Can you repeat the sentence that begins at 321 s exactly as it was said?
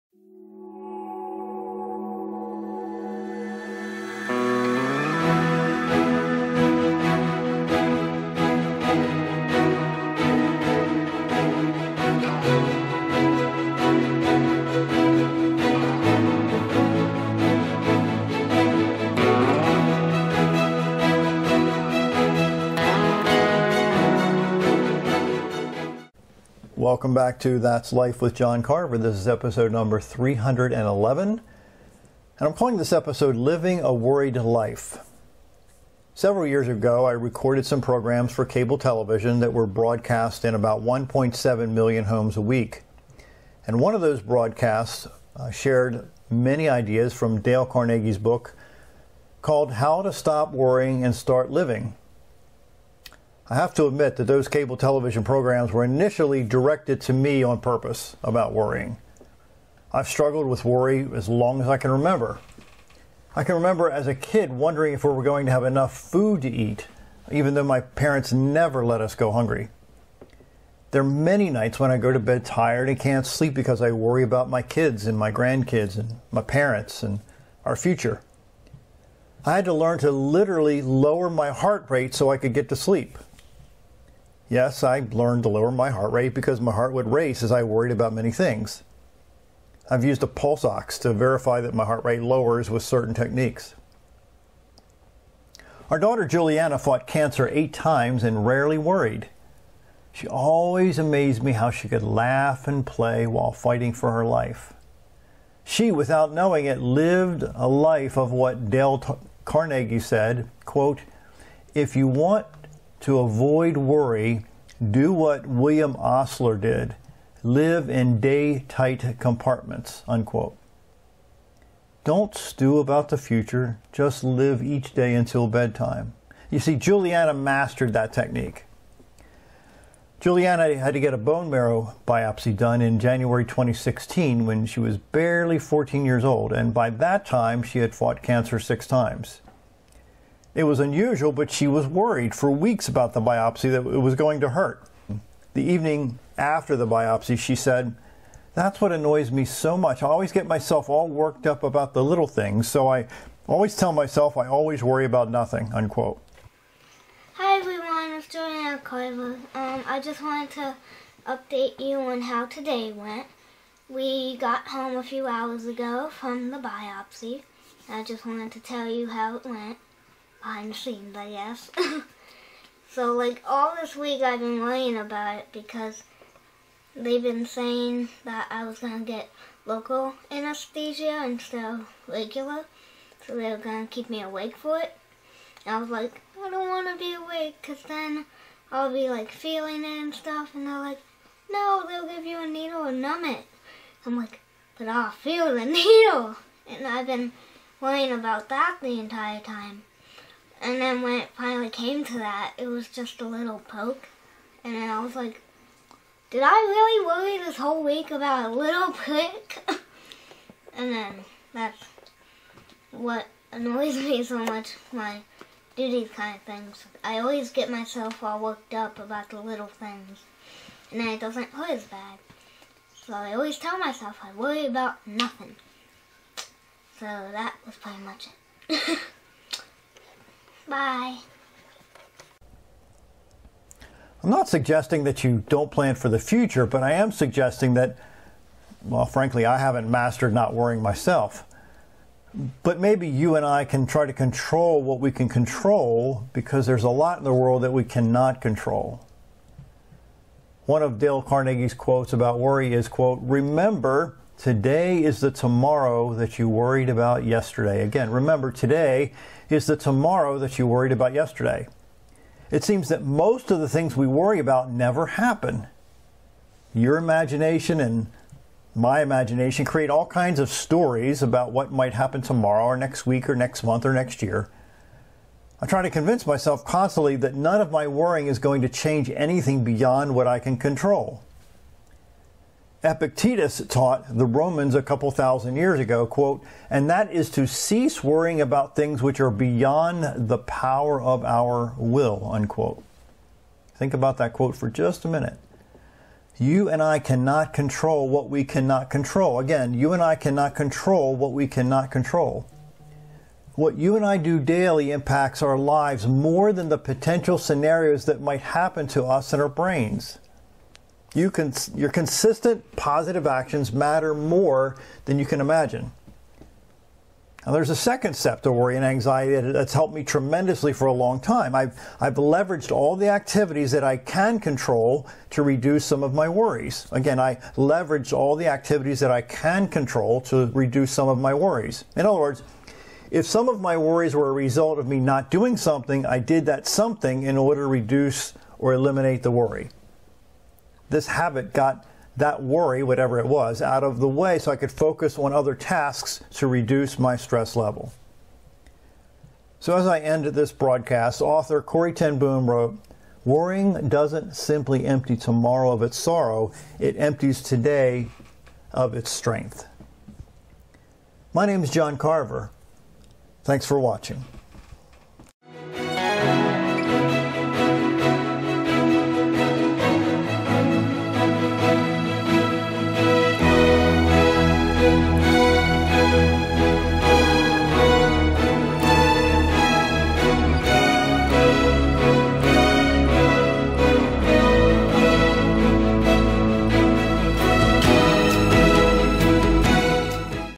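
I've, I've leveraged all the activities that I can control to reduce some of my worries.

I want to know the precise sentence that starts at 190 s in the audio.
And they're like, no, they'll give you a needle and numb it.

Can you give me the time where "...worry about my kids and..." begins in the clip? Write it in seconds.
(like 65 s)
73 s.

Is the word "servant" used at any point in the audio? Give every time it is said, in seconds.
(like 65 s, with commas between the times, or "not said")
not said.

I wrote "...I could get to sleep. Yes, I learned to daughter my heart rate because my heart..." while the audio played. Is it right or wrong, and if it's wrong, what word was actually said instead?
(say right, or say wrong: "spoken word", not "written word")
wrong: "lower", not "daughter".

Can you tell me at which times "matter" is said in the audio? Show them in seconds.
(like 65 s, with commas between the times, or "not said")
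313 s.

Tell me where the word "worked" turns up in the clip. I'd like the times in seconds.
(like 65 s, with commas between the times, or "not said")
151 s, 218 s.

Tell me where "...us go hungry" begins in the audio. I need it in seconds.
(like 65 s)
68 s.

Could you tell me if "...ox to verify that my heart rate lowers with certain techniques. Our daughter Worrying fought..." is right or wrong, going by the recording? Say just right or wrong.
wrong.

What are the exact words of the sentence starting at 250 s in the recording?
One of Dale Carnegie's quotes about worry is, quote, remember Today is the tomorrow that you worried about yesterday.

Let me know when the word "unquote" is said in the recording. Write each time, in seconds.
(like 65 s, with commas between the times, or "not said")
120 s, 155 s, 292 s.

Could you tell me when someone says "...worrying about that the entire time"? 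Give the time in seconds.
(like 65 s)
197 s.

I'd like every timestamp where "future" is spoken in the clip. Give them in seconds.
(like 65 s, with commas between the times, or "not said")
77 s, 123 s, 236 s.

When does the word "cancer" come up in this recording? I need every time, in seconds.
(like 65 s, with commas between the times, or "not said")
97 s, 138 s.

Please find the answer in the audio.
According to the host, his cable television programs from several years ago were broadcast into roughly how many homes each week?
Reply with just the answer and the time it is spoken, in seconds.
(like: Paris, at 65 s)
1.7 million, at 40 s.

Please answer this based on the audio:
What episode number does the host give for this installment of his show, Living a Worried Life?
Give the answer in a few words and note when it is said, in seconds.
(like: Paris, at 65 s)
311, at 29 s.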